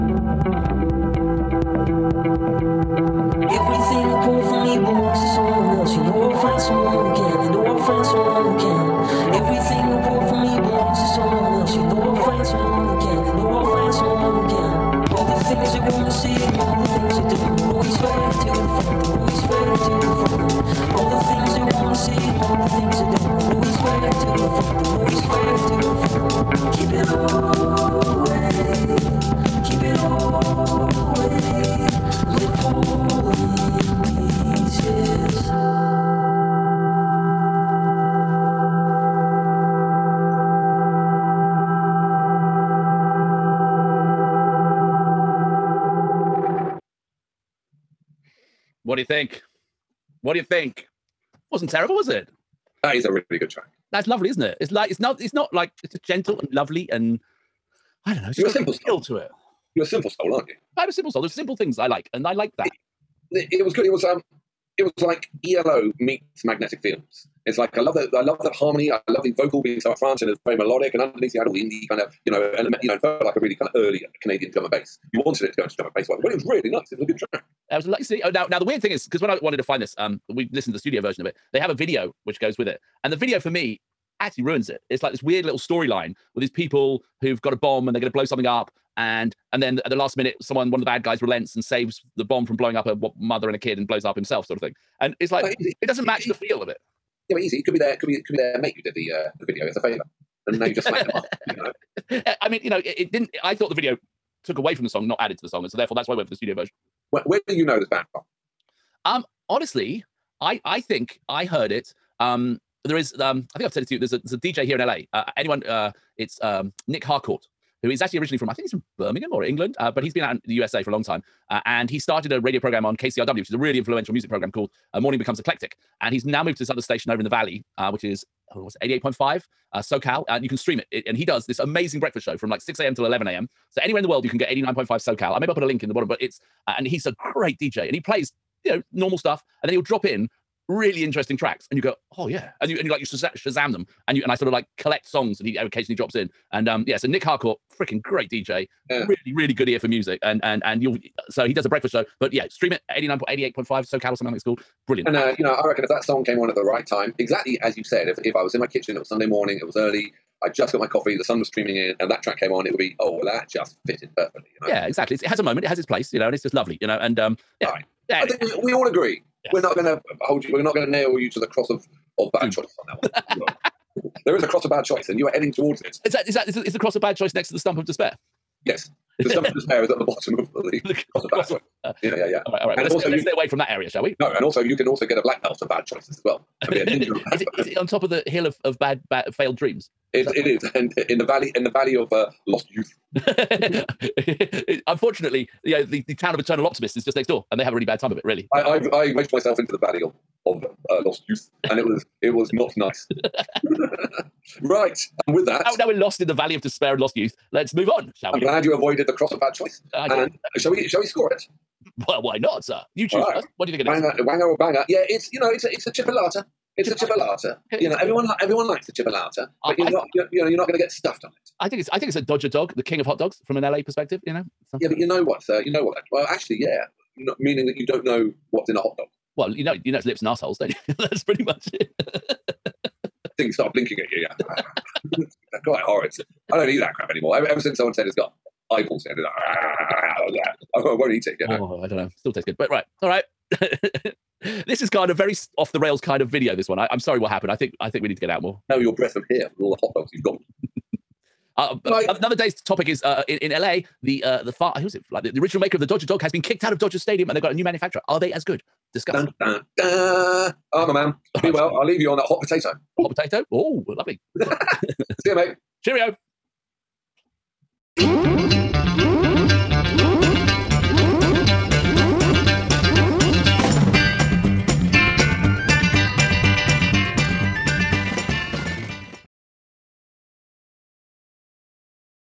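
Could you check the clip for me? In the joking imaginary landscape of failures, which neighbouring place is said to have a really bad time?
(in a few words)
town of eternal optimists.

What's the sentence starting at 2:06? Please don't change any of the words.
And he's now moved to this other station over in the valley, uh, which is oh, what's it, 88.5 uh, SoCal.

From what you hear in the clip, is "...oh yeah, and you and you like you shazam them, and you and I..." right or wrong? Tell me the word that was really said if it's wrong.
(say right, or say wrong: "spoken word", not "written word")
right.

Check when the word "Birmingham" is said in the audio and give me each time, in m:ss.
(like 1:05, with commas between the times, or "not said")
1:58.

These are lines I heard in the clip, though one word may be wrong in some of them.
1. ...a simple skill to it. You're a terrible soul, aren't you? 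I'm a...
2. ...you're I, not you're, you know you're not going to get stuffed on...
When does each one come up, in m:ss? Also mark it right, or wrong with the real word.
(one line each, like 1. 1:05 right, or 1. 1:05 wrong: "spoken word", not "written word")
1. 0:58 wrong: "simple", not "terrible"
2. 3:39 right.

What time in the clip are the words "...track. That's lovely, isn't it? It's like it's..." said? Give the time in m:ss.
0:53.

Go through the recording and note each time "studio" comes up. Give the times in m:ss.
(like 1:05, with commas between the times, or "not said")
1:20, 1:46.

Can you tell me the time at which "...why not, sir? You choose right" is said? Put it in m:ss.
3:32.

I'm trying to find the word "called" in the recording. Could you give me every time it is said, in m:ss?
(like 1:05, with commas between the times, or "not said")
2:04, 2:34.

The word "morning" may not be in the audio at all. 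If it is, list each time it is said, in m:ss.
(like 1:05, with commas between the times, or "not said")
2:04, 2:39.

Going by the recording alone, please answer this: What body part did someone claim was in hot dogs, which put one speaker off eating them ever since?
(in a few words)
eyeballs.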